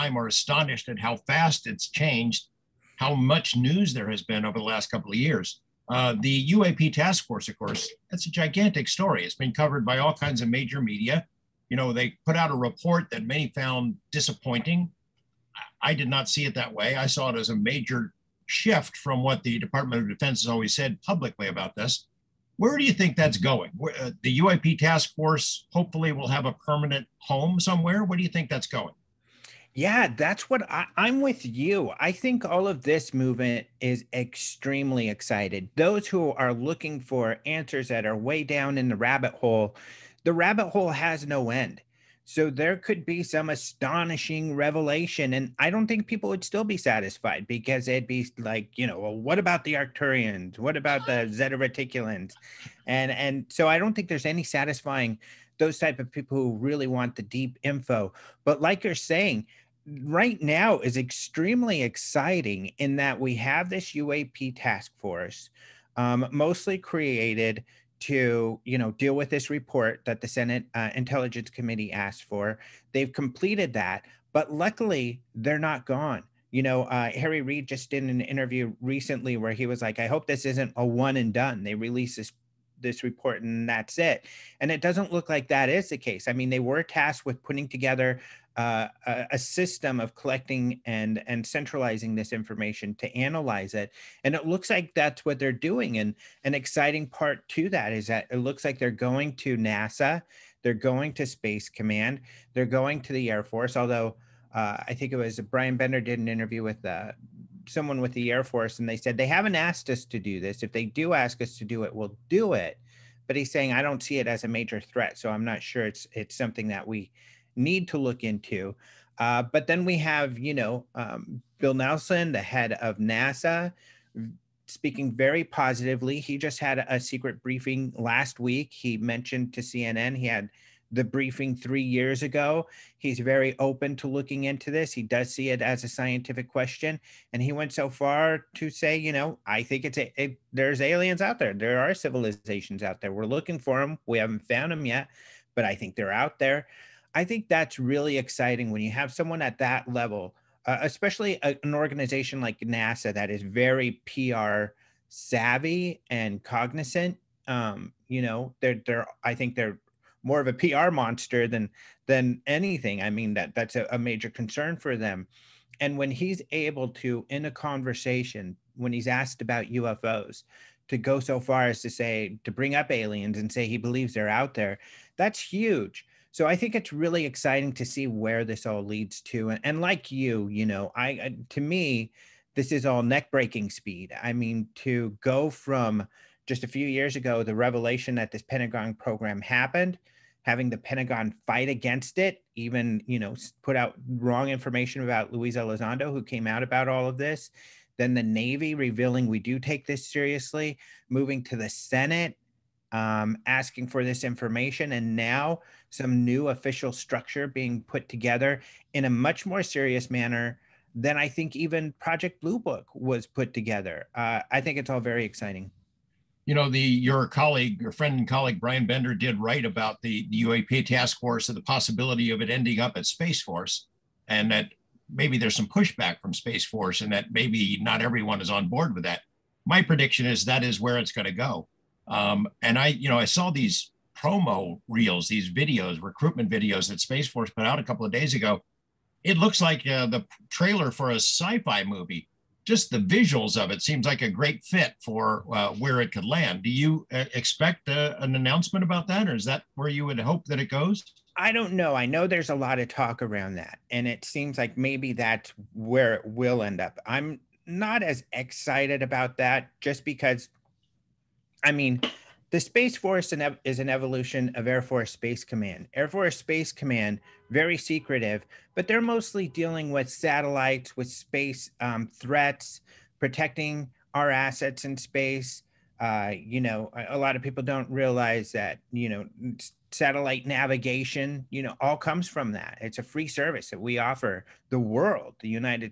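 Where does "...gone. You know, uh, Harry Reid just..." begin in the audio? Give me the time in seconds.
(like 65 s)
75 s.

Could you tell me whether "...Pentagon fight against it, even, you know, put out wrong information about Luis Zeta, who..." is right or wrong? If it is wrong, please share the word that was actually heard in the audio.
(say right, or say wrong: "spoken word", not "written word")
wrong: "Elizondo", not "Zeta".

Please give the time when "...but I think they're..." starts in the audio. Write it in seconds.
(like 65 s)
145 s.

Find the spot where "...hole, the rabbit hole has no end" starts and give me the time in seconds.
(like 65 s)
39 s.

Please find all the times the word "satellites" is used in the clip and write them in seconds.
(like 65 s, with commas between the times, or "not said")
270 s, 279 s.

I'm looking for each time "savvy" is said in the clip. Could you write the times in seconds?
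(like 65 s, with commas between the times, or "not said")
155 s.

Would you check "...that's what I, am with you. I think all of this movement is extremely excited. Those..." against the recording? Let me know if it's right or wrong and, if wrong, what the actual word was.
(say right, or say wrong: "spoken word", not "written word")
right.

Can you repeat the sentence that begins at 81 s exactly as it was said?
They release this this report and that's it." And it doesn't look like that is the case.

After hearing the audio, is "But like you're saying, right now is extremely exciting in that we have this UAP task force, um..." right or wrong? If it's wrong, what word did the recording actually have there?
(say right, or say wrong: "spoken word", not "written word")
right.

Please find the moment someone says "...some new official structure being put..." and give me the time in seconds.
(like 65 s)
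205 s.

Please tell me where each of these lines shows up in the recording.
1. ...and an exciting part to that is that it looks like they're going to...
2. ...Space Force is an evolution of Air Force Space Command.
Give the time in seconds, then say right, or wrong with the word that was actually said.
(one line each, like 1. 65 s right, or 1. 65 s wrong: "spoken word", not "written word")
1. 95 s right
2. 262 s right.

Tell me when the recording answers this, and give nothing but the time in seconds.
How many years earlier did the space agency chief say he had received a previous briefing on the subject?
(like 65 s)
131 s.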